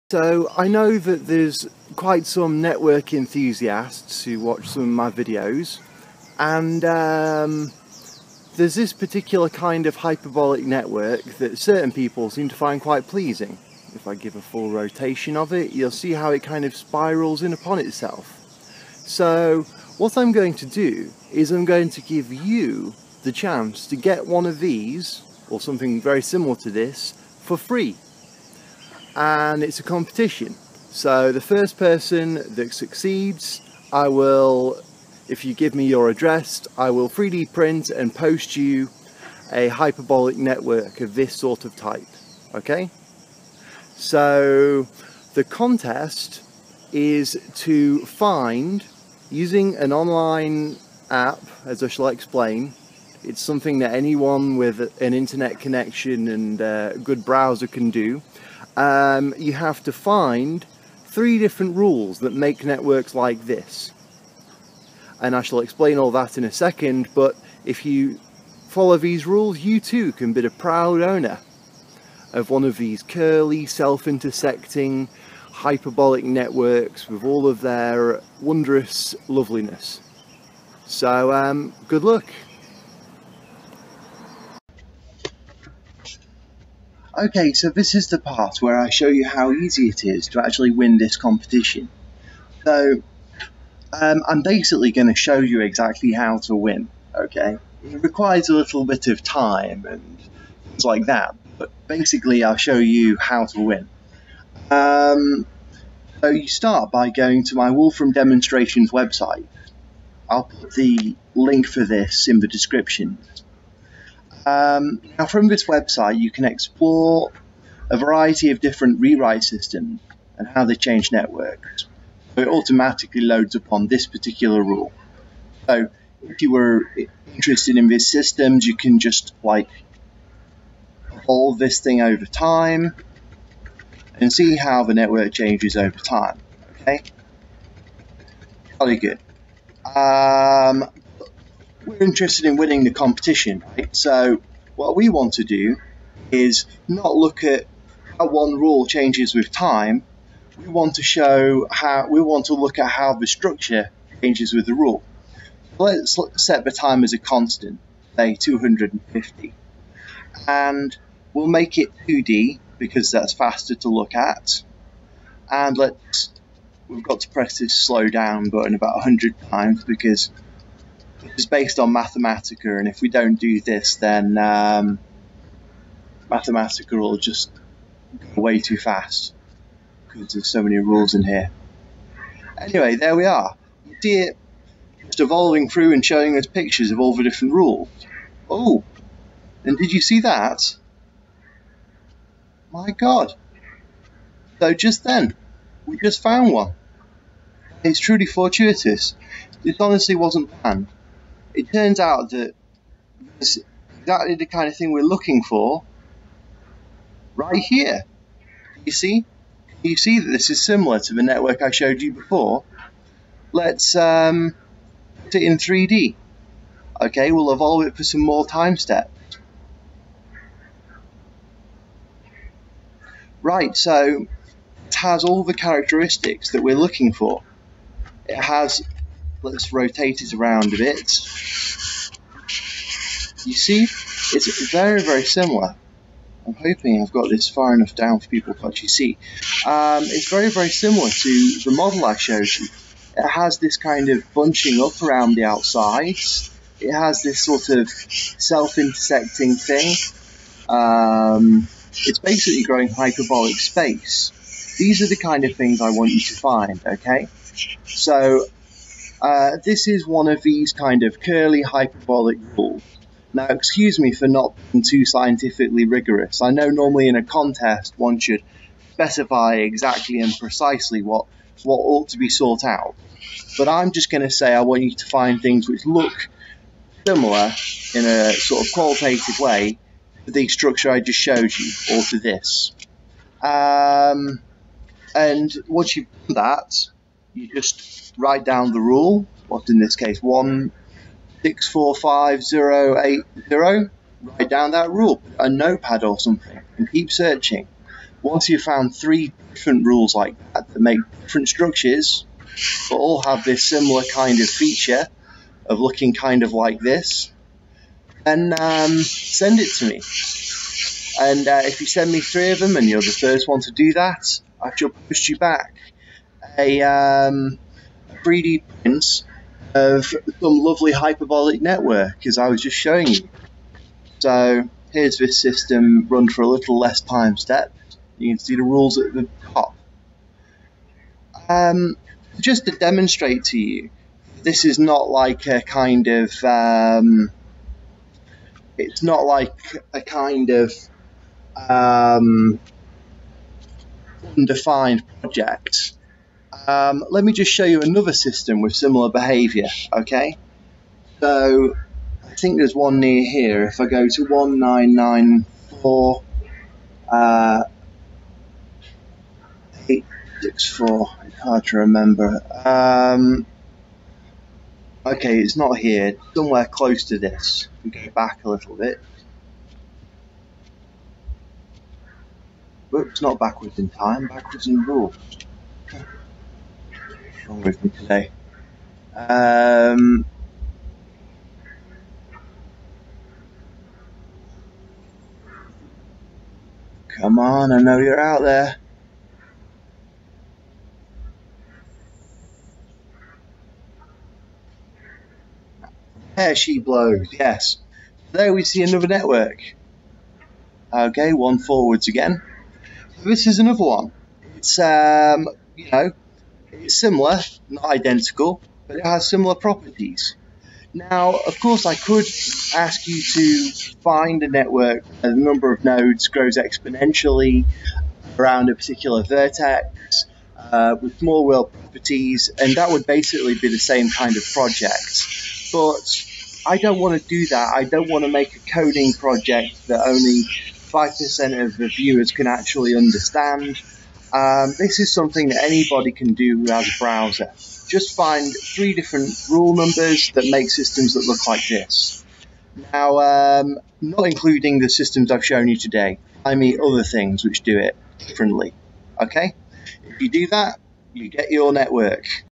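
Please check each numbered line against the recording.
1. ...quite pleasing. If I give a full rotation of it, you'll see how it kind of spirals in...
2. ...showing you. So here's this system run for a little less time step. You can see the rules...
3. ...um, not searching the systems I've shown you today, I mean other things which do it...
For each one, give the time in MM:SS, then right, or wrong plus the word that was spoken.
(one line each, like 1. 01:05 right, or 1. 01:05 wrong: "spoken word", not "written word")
1. 00:12 right
2. 05:22 right
3. 07:23 wrong: "including", not "searching".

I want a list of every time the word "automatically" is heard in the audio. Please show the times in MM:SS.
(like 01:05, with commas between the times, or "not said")
02:02.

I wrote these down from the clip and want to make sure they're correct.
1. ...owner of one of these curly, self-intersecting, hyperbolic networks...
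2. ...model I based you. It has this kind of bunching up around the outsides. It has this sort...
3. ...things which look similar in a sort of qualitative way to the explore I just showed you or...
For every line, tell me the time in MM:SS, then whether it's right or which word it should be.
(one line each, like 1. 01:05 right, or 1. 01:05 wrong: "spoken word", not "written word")
1. 01:11 right
2. 04:01 wrong: "showed", not "based"
3. 04:35 wrong: "structure", not "explore".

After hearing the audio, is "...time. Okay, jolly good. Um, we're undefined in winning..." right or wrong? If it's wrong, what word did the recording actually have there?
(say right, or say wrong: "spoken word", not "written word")
wrong: "interested", not "undefined".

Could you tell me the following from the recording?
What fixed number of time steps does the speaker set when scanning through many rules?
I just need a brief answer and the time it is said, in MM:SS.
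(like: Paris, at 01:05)
250, at 02:38.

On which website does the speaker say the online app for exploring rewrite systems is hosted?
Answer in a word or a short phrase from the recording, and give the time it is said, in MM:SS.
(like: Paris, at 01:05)
Wolfram Demonstrations, at 01:47.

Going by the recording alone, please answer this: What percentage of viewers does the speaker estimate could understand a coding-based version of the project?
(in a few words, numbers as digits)
5%.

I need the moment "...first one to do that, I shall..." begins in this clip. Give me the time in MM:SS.
05:13.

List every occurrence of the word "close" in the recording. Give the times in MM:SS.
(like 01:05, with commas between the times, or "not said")
06:06.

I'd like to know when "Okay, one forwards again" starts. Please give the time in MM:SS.
06:40.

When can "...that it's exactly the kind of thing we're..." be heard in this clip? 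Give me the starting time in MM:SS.
03:22.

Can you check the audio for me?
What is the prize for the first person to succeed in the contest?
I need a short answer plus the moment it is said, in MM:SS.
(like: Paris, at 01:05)
3D printed hyperbolic network, at 00:37.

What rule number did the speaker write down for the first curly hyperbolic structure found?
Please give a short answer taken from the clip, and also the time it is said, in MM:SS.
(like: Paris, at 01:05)
1645080, at 04:50.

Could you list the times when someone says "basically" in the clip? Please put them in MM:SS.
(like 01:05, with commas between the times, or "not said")
01:34, 01:41, 04:12, 07:03.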